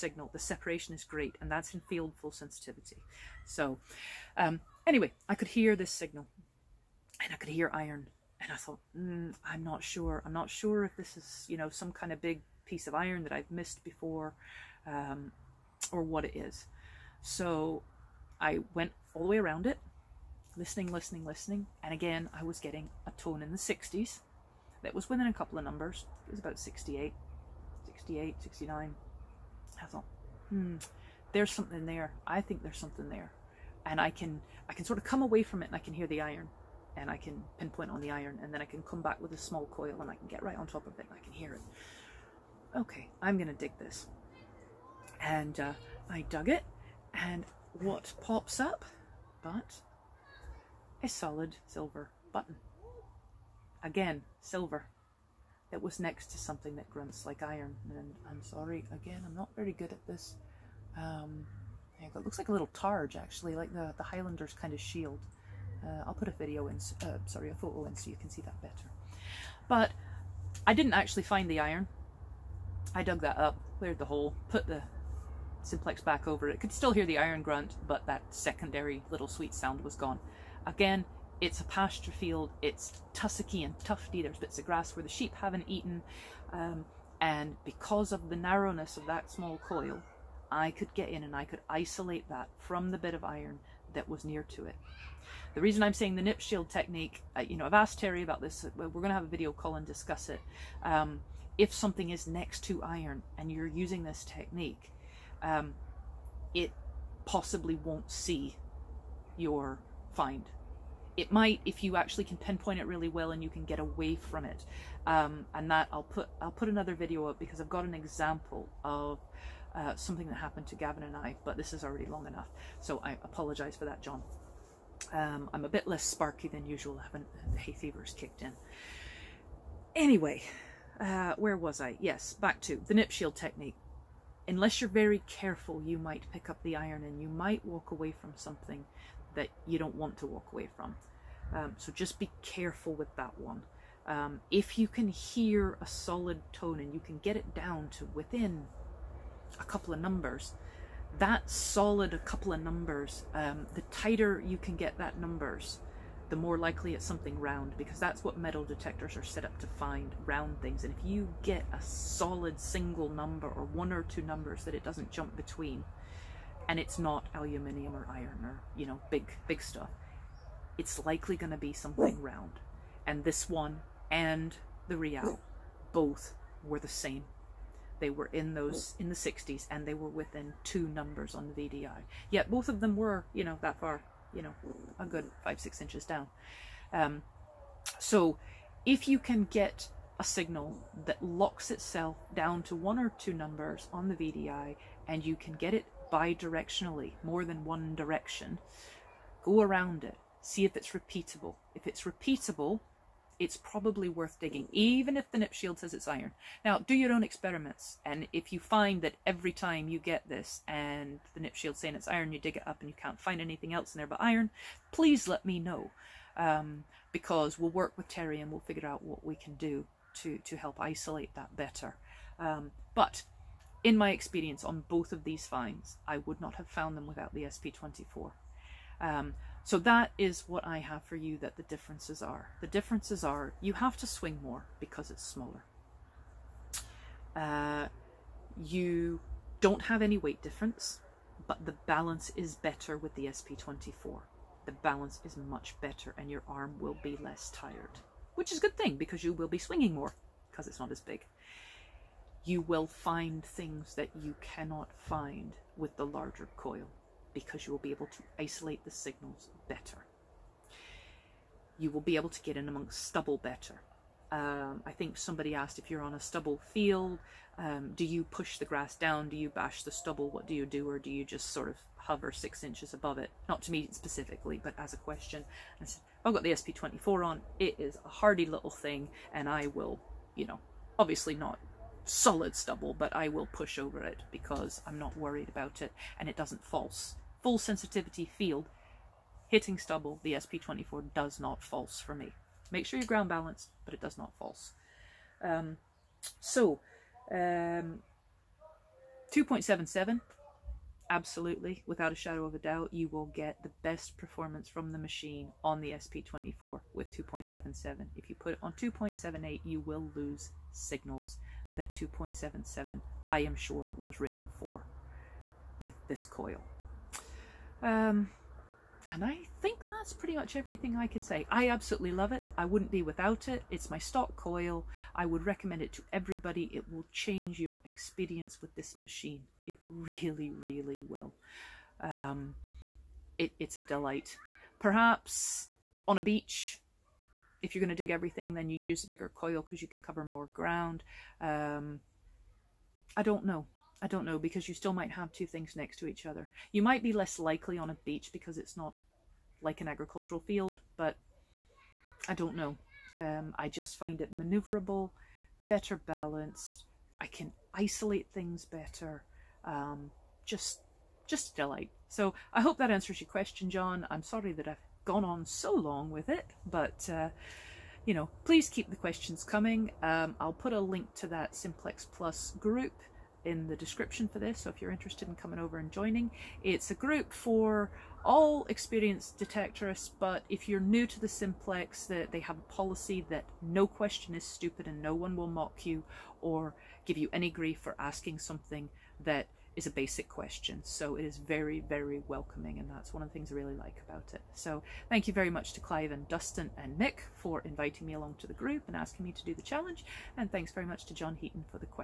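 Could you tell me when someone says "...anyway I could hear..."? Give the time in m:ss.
0:04.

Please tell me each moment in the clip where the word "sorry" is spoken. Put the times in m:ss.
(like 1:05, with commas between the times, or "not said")
0:58, 1:07, 6:04.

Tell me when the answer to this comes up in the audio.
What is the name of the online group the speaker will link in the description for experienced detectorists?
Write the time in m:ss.
6:11.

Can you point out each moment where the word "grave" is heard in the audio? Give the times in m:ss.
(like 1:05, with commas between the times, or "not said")
not said.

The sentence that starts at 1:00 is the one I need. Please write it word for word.
Um, it looks like a little targe, actually, like the, the Highlander's kind of shield.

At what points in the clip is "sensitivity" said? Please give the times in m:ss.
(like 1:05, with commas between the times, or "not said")
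0:02, 4:47.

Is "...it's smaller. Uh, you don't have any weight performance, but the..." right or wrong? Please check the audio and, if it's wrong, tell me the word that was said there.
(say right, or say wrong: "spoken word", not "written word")
wrong: "difference", not "performance".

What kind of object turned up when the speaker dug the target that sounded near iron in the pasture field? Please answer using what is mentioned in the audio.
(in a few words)
Solid silver button.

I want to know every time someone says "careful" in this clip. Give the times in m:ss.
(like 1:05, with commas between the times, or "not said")
2:15, 2:22.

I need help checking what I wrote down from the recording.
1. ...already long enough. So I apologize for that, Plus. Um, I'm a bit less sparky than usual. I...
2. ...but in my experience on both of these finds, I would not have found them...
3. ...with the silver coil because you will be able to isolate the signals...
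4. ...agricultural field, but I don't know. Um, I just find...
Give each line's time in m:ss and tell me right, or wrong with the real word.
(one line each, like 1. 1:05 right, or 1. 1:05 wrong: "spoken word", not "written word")
1. 2:01 wrong: "John", not "Plus"
2. 3:42 right
3. 4:15 wrong: "larger", not "silver"
4. 5:49 right.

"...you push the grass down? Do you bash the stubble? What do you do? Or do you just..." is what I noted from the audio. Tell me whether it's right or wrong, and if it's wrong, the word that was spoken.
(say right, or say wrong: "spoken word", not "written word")
right.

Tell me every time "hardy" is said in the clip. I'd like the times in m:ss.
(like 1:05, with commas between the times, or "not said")
4:38.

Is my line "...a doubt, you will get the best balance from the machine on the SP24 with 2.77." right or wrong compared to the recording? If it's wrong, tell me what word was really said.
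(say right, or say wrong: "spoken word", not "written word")
wrong: "performance", not "balance".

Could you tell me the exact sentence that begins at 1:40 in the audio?
Um, if something is next to iron and you're using this technique, um, it possibly won't see your find.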